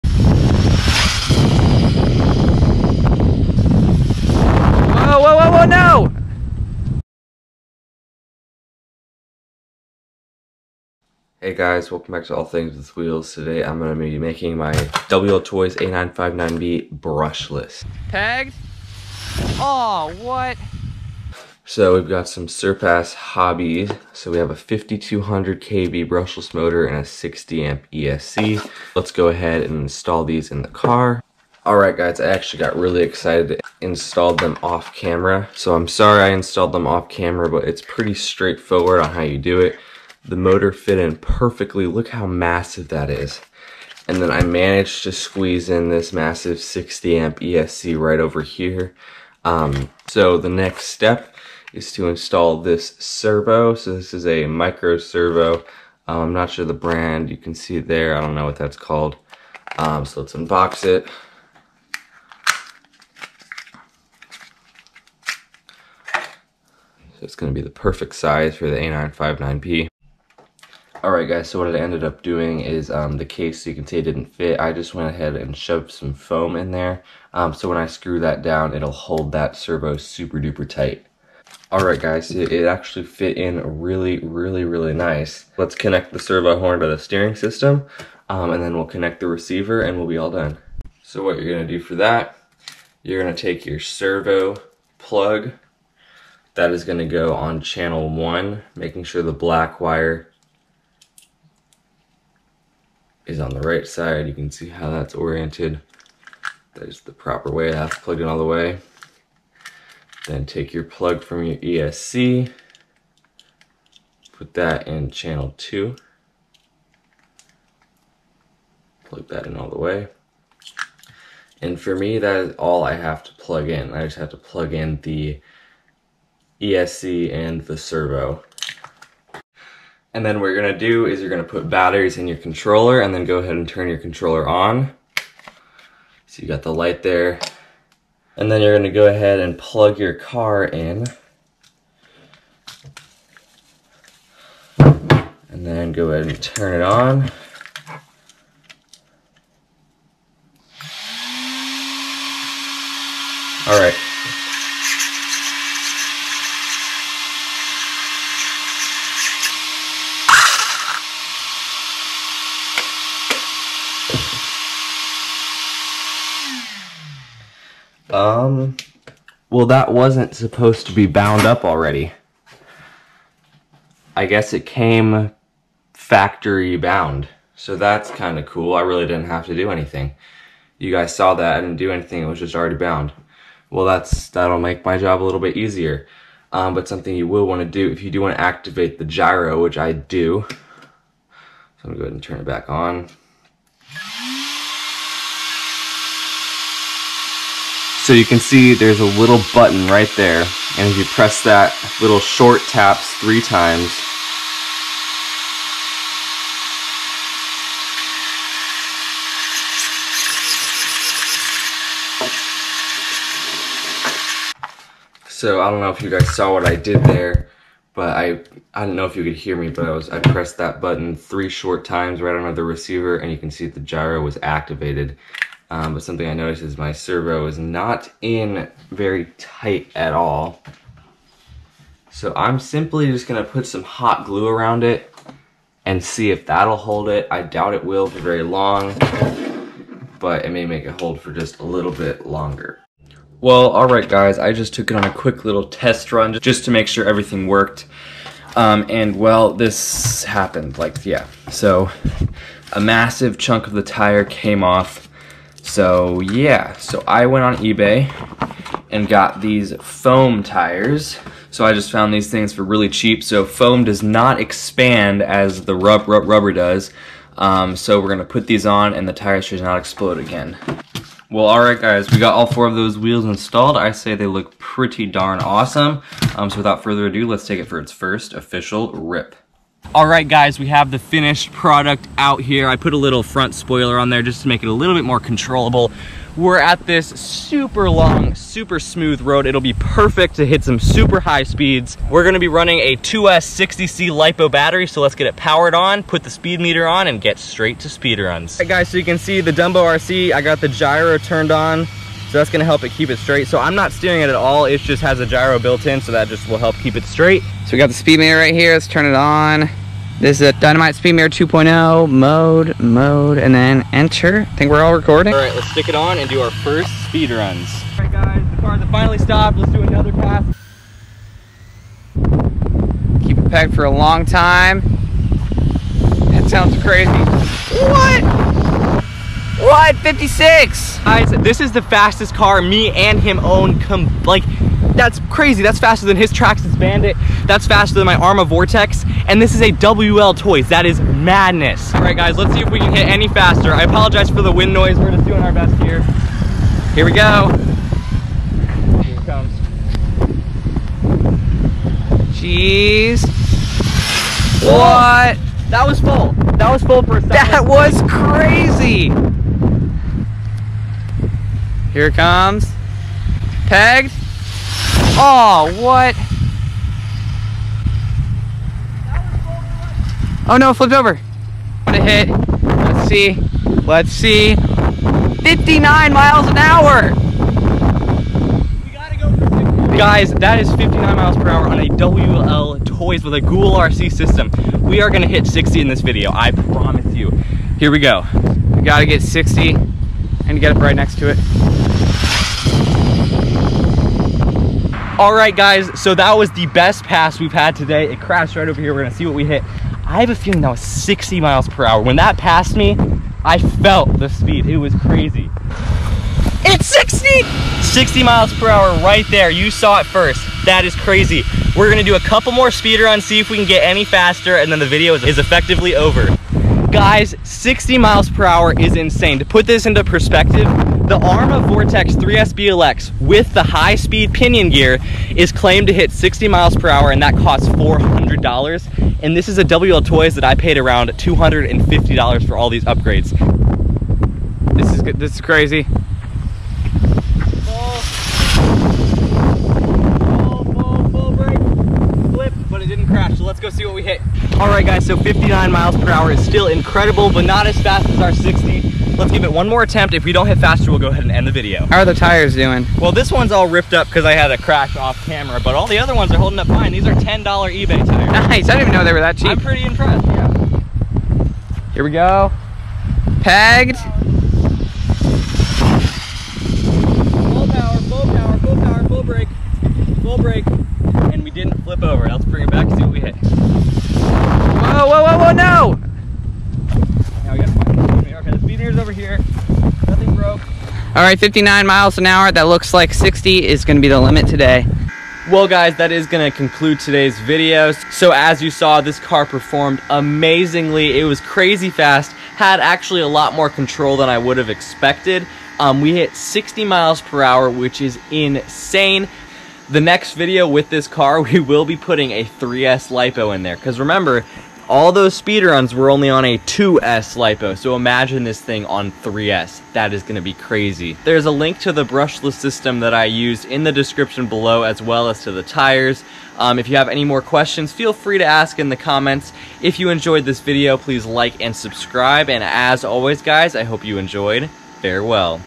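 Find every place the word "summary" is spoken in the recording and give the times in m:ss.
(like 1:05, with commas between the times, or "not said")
not said.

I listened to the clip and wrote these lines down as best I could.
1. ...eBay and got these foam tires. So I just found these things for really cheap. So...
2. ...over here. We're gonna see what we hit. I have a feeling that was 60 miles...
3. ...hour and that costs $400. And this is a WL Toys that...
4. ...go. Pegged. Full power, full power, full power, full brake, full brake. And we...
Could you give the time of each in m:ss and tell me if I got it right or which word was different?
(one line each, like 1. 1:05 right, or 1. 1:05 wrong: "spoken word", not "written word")
1. 4:17 right
2. 6:38 right
3. 7:06 right
4. 7:42 right.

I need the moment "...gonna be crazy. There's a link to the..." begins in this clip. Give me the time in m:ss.
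8:30.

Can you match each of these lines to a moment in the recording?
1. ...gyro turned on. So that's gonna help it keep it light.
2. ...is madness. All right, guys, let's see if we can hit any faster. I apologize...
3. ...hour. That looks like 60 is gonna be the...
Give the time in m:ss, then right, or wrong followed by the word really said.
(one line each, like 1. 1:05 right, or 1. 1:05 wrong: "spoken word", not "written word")
1. 5:00 wrong: "straight", not "light"
2. 5:40 right
3. 8:02 right.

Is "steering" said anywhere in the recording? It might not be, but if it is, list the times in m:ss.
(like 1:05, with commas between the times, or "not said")
1:26, 5:03.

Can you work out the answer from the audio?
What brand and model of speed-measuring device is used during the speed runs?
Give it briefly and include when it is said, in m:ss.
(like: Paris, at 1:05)
Dynamite Speed Meter 2.0, at 5:10.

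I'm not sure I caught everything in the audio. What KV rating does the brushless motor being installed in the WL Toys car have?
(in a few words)
5200 KV.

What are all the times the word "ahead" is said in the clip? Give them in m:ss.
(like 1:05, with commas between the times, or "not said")
0:29, 1:15, 2:13, 2:19, 2:26, 3:12, 7:31.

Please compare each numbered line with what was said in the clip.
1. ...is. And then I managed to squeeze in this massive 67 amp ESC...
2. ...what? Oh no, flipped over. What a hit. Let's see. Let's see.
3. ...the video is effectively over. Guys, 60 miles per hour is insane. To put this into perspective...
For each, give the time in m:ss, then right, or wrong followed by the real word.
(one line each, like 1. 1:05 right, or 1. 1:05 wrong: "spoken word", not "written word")
1. 0:43 wrong: "60", not "67"
2. 6:05 right
3. 6:54 right.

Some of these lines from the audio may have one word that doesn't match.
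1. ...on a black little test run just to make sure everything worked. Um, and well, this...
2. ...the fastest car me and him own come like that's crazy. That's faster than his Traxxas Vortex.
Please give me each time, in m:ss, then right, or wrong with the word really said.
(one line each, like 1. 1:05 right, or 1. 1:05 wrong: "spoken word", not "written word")
1. 4:04 wrong: "quick", not "black"
2. 5:31 wrong: "Bandit", not "Vortex".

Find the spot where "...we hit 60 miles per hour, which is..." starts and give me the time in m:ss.
8:16.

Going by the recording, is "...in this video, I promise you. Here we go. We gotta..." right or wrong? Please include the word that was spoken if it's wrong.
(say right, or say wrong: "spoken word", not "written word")
right.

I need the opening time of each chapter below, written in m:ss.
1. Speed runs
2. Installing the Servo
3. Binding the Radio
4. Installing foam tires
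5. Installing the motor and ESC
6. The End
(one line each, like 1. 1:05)
1. 4:40
2. 0:51
3. 1:27
4. 4:02
5. 0:12
6. 8:07.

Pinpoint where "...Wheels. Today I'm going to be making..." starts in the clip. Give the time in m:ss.
0:12.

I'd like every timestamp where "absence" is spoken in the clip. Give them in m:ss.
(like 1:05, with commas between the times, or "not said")
not said.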